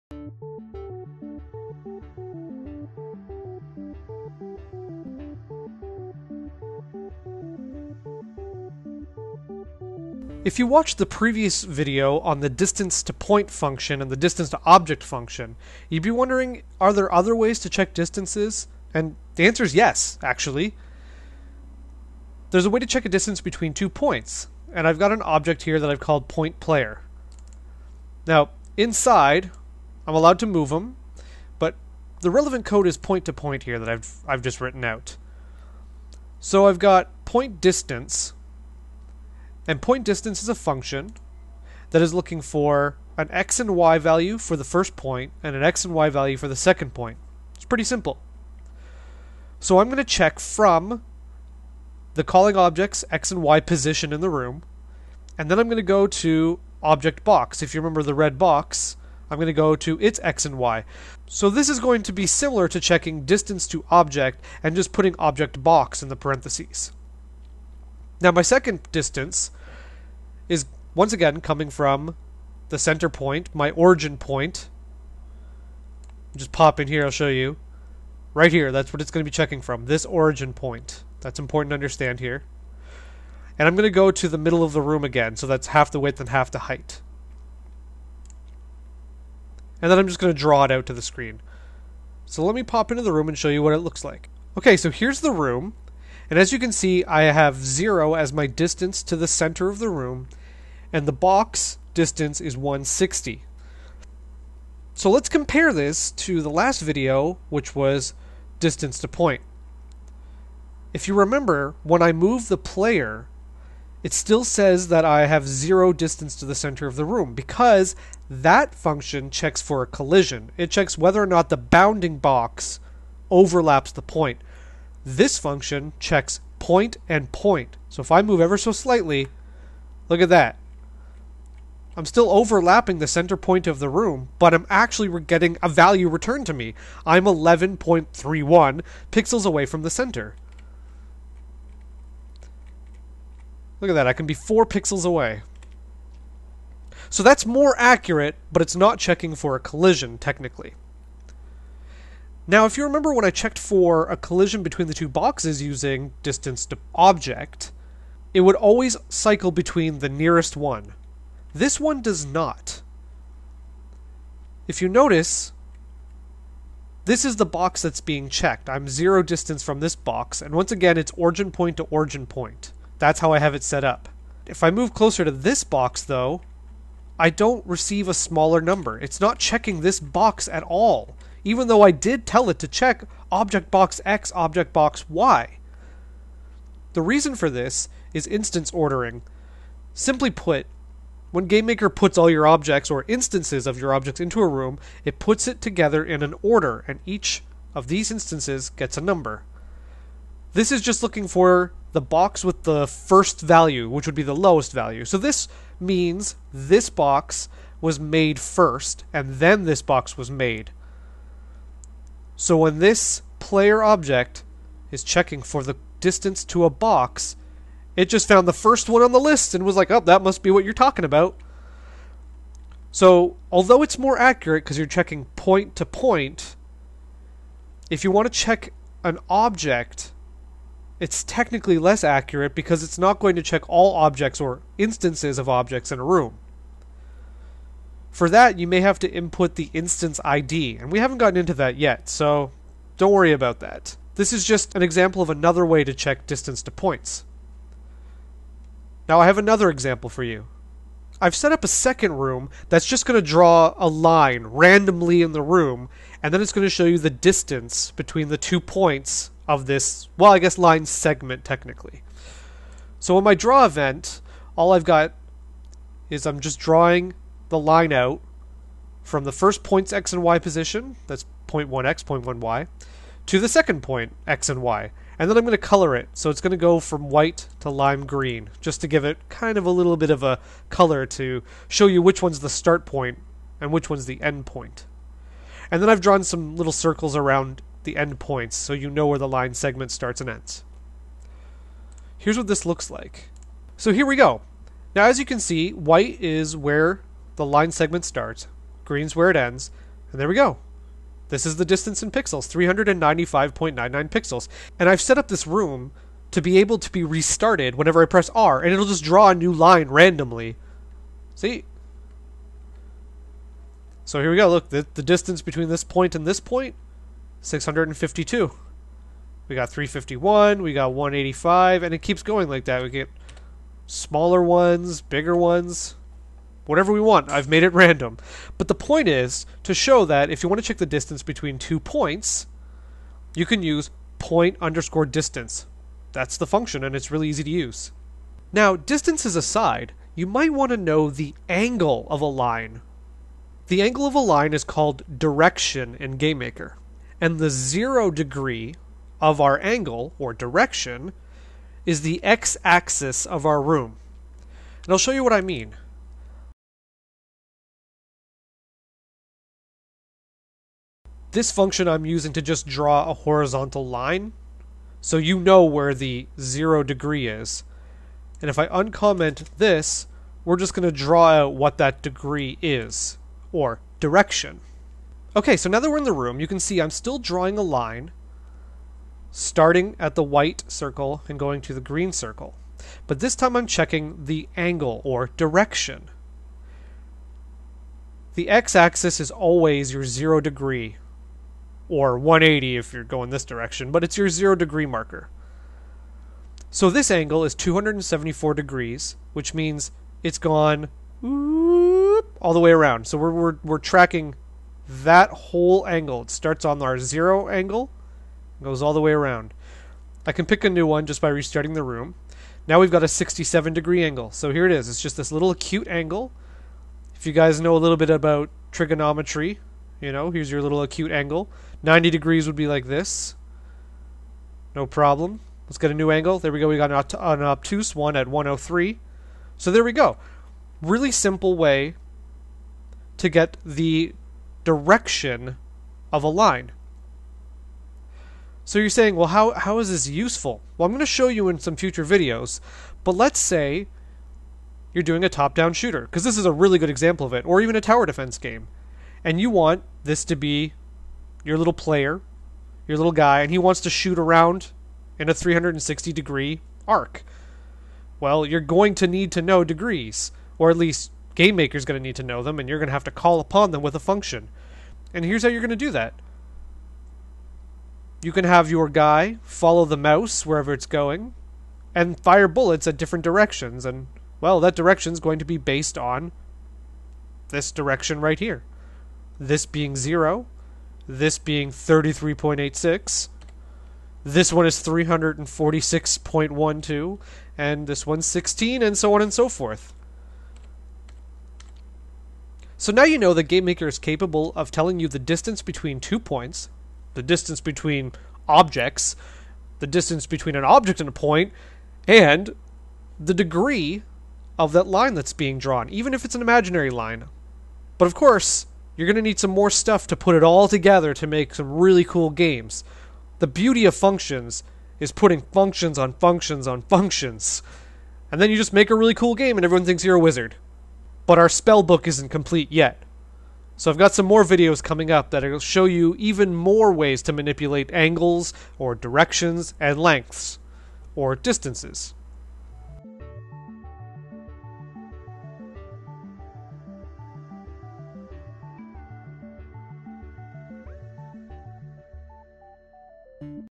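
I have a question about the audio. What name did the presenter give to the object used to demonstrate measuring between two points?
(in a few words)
point player.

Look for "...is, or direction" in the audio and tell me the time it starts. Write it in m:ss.
6:12.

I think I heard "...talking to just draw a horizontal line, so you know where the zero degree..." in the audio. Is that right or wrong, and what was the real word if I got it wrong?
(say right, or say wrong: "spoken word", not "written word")
wrong: "using", not "talking".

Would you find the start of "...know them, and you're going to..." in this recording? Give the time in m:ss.
7:42.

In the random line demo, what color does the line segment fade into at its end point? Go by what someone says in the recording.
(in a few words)
lime green.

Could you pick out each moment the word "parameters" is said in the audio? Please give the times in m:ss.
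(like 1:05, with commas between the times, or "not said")
not said.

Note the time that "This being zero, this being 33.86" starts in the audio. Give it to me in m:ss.
7:59.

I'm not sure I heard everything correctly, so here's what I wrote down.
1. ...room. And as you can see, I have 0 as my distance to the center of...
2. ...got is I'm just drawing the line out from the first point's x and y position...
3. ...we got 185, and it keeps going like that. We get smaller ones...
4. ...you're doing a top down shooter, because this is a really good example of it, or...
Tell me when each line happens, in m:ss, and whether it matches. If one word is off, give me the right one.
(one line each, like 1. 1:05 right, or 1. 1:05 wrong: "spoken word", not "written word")
1. 1:35 right
2. 4:24 right
3. 5:20 right
4. 7:24 right.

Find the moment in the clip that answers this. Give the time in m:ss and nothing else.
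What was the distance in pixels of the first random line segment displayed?
5:02.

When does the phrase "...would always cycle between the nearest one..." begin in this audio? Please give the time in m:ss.
2:38.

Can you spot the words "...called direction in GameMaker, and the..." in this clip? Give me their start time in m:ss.
5:44.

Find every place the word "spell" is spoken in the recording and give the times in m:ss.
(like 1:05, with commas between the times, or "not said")
8:41.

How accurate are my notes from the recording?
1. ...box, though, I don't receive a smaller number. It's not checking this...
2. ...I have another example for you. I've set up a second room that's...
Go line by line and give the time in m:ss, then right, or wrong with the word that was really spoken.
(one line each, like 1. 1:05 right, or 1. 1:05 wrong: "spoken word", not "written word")
1. 2:55 right
2. 4:09 right.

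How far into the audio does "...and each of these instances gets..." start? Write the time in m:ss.
3:16.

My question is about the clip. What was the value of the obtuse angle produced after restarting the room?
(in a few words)
103.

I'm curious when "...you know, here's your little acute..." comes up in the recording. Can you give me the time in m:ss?
6:59.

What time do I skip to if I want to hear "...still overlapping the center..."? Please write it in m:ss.
2:12.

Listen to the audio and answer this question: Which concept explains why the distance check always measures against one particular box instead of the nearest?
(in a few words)
instance ordering.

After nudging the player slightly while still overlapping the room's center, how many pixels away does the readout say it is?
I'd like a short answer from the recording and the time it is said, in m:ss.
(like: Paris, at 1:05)
11.31, at 2:17.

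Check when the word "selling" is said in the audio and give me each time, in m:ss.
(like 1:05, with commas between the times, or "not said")
not said.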